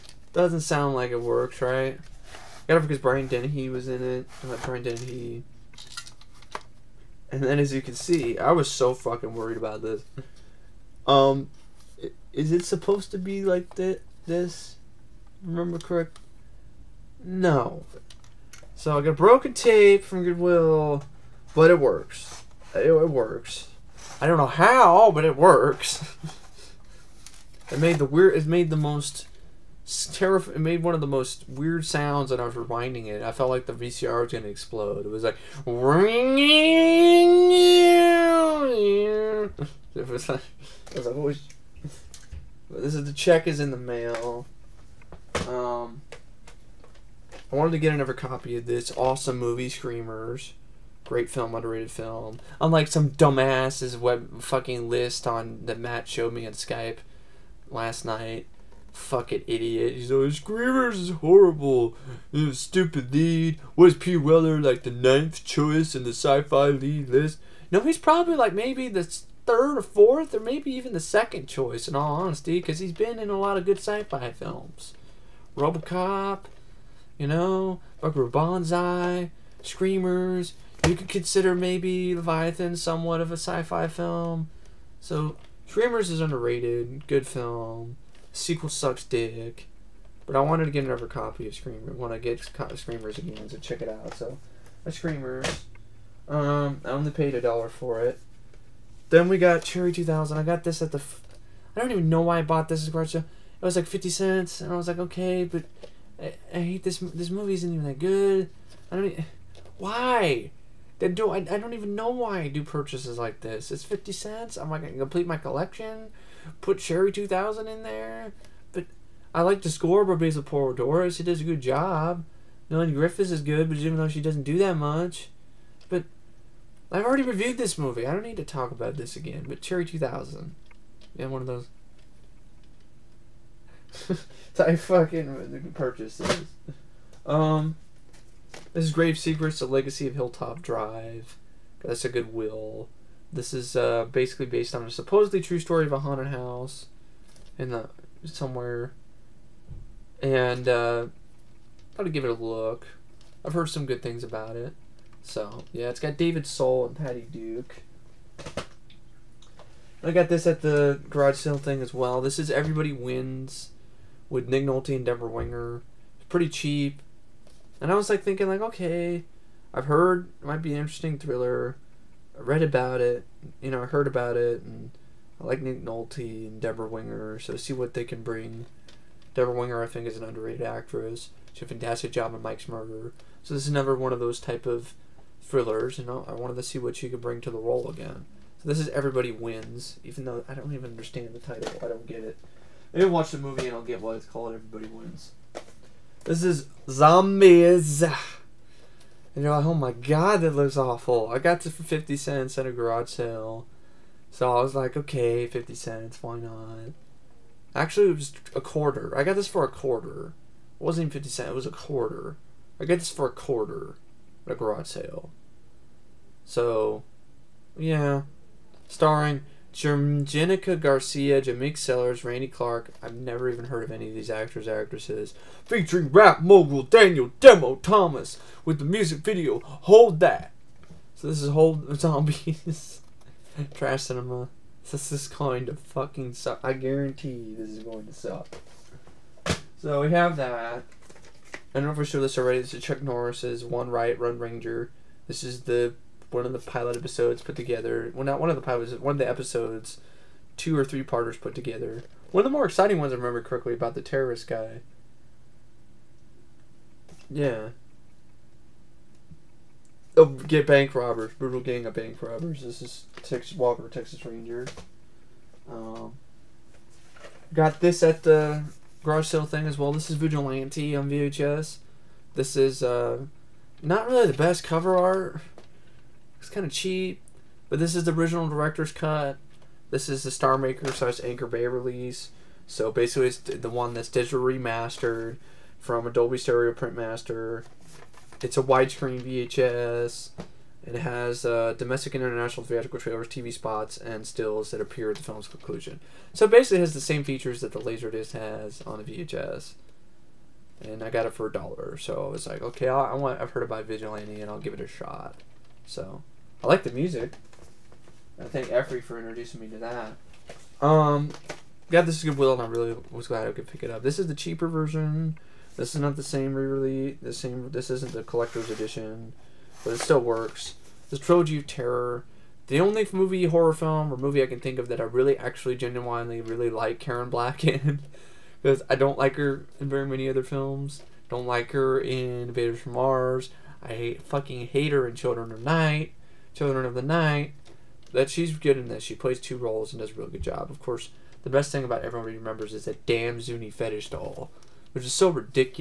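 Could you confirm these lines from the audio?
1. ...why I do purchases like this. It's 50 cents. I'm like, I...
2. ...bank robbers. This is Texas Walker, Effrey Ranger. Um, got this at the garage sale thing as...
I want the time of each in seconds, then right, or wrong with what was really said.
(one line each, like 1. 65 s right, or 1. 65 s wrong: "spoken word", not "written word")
1. 112 s right
2. 261 s wrong: "Texas", not "Effrey".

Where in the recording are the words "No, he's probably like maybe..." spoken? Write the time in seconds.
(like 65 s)
67 s.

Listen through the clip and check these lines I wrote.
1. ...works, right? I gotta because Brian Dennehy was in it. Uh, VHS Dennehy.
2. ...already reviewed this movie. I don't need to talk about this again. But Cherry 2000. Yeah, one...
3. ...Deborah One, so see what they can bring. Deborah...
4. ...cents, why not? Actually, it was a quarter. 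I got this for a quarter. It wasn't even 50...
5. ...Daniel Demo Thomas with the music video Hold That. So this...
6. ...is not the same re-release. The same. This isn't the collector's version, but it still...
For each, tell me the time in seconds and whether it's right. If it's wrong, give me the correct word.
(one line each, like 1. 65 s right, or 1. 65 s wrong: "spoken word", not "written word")
1. 1 s wrong: "Brian", not "VHS"
2. 127 s right
3. 176 s wrong: "Winger", not "One"
4. 205 s right
5. 226 s right
6. 315 s wrong: "edition", not "version".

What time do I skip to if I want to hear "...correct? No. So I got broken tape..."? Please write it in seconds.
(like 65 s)
15 s.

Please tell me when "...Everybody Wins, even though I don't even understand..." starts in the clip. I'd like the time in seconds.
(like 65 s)
188 s.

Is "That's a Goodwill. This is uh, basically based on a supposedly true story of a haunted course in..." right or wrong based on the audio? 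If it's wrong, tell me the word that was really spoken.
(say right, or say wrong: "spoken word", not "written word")
wrong: "house", not "course".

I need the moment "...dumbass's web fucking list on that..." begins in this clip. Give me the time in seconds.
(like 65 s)
53 s.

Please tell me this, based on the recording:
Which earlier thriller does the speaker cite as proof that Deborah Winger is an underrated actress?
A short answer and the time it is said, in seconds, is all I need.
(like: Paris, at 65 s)
Mike's Murder, at 182 s.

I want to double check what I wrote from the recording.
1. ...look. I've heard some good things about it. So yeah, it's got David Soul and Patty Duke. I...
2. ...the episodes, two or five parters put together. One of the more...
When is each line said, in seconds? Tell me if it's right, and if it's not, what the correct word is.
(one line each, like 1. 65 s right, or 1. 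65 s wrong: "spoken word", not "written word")
1. 152 s right
2. 249 s wrong: "three", not "five".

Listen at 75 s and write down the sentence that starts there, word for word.
RoboCop, you know, Buckaroo Banzai, Screamers.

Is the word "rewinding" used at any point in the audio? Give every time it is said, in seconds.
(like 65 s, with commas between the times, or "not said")
32 s.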